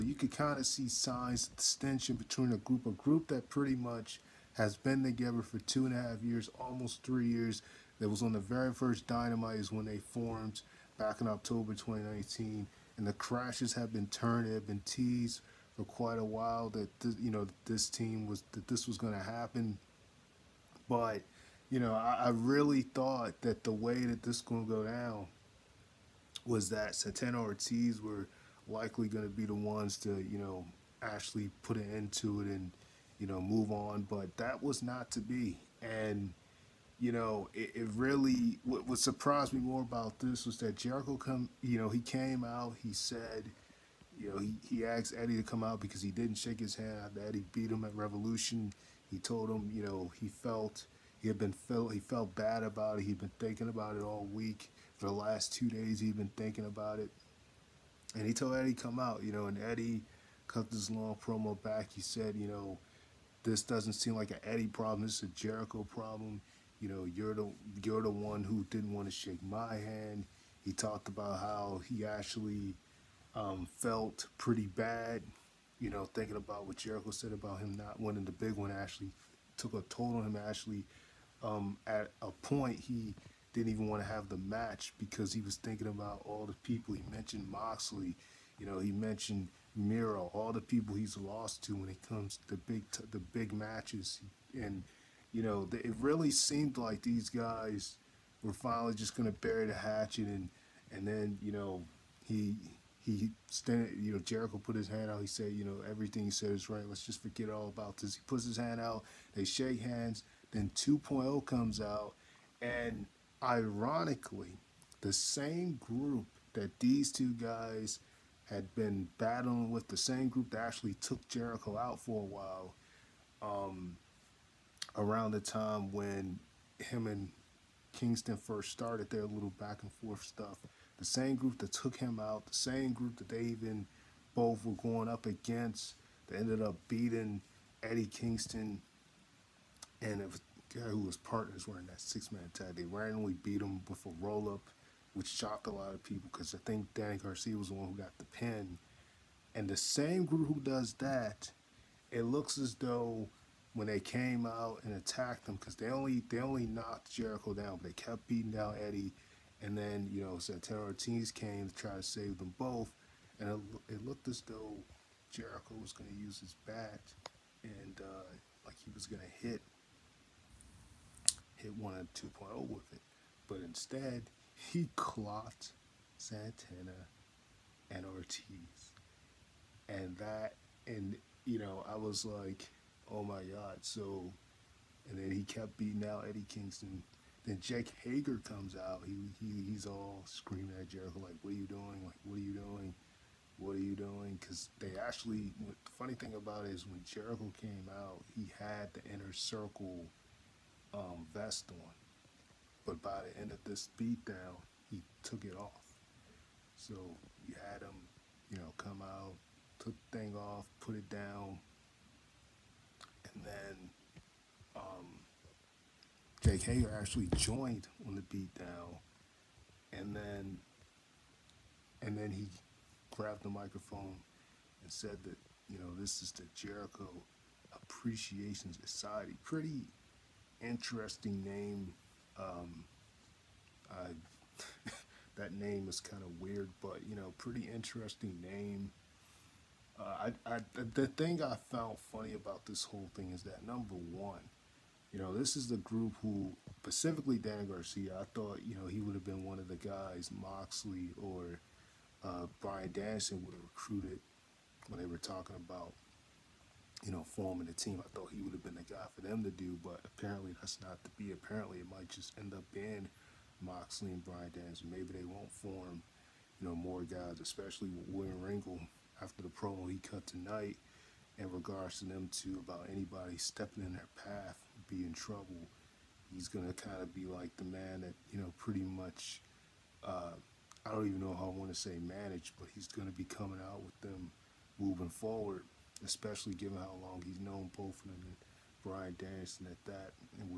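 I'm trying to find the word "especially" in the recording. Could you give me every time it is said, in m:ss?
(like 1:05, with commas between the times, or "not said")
4:27, 4:46.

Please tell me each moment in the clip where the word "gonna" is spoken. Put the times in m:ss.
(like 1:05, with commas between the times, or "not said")
4:36, 4:42.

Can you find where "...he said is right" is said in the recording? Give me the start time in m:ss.
1:46.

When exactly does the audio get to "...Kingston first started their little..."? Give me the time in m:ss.
2:07.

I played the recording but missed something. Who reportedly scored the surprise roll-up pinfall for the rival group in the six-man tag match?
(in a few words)
Danny Garcia.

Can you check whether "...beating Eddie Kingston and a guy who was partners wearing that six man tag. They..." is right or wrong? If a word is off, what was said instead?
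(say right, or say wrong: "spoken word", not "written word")
right.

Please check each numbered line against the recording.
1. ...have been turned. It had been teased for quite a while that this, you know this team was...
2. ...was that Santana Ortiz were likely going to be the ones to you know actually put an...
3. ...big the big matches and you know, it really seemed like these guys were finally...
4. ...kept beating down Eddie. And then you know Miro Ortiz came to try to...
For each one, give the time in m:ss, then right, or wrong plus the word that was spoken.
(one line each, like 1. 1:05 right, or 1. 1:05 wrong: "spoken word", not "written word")
1. 0:13 right
2. 0:26 right
3. 1:32 right
4. 2:37 wrong: "Santana", not "Miro".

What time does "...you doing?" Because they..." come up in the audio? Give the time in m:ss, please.
3:13.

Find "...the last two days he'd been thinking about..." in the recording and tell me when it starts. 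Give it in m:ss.
0:55.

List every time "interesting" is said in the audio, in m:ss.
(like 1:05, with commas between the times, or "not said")
3:50, 3:57.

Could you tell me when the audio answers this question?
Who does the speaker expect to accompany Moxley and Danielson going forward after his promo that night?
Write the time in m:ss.
4:28.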